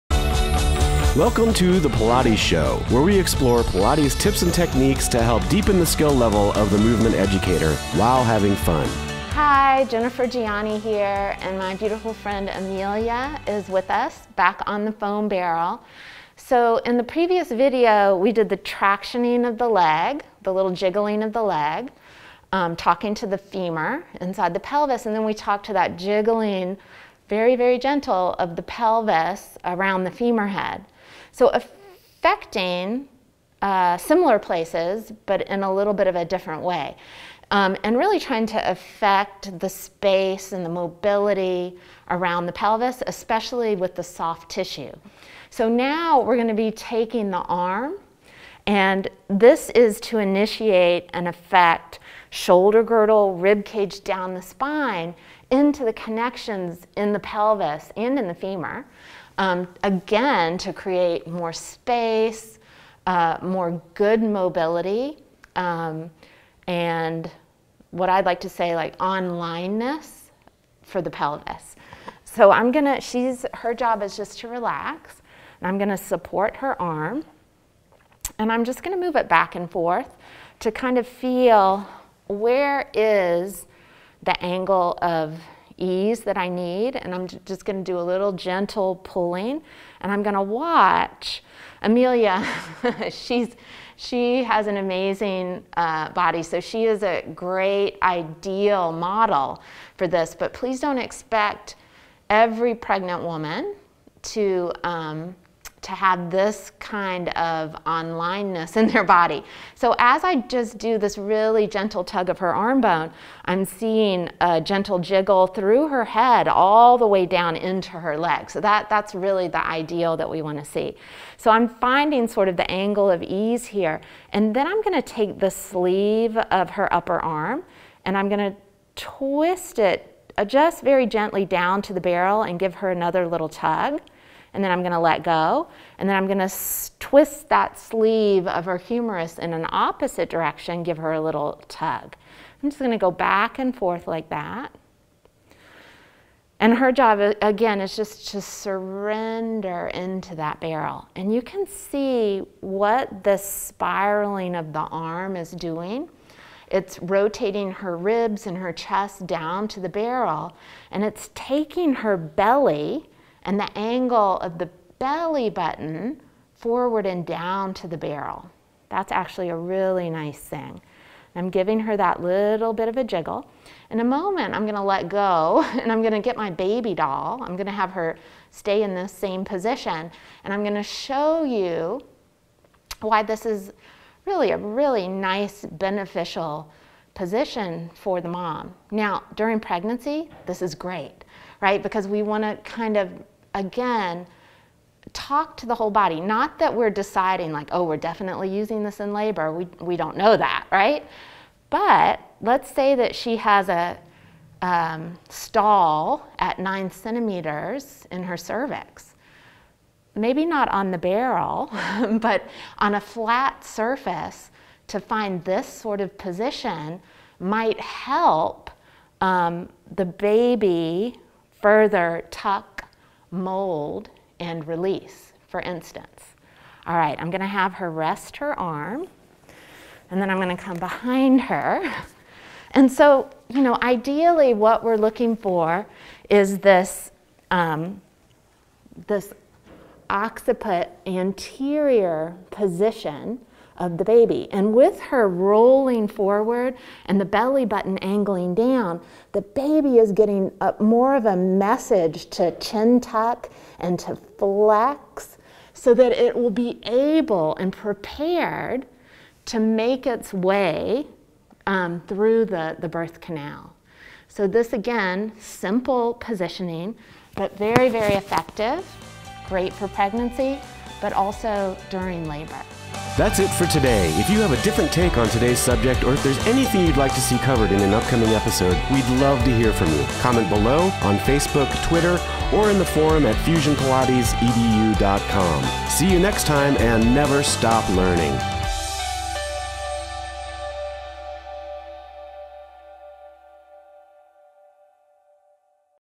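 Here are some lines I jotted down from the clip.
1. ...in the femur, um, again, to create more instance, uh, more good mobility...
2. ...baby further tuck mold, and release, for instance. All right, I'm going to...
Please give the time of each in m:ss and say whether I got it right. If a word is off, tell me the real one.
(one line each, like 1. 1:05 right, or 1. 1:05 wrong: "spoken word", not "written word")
1. 0:58 wrong: "space", not "instance"
2. 3:40 right.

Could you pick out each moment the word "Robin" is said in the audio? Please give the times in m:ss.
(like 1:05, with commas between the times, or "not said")
not said.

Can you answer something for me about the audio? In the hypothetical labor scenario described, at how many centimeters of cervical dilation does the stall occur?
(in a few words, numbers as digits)
9.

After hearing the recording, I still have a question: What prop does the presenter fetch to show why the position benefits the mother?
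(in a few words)
baby doll.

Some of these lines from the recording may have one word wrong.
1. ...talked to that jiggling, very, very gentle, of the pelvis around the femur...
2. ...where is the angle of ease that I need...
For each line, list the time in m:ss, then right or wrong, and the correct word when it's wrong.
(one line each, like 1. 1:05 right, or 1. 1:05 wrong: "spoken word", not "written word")
1. 0:25 right
2. 1:22 right.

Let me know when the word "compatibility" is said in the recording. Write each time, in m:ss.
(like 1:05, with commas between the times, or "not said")
not said.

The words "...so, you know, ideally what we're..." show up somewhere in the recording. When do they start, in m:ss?
3:52.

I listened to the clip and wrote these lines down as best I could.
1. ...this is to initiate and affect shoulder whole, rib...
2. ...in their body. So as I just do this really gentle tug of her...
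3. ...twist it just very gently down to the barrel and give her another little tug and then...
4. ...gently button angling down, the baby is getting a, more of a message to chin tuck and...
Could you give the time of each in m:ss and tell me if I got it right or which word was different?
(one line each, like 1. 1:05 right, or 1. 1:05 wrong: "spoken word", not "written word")
1. 0:49 wrong: "girdle", not "whole"
2. 1:48 right
3. 2:08 right
4. 4:07 wrong: "belly", not "gently".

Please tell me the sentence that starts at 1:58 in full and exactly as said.
So that, that's really the ideal that we want to see.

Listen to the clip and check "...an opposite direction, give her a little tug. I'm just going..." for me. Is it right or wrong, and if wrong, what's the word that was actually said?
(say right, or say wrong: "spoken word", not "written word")
right.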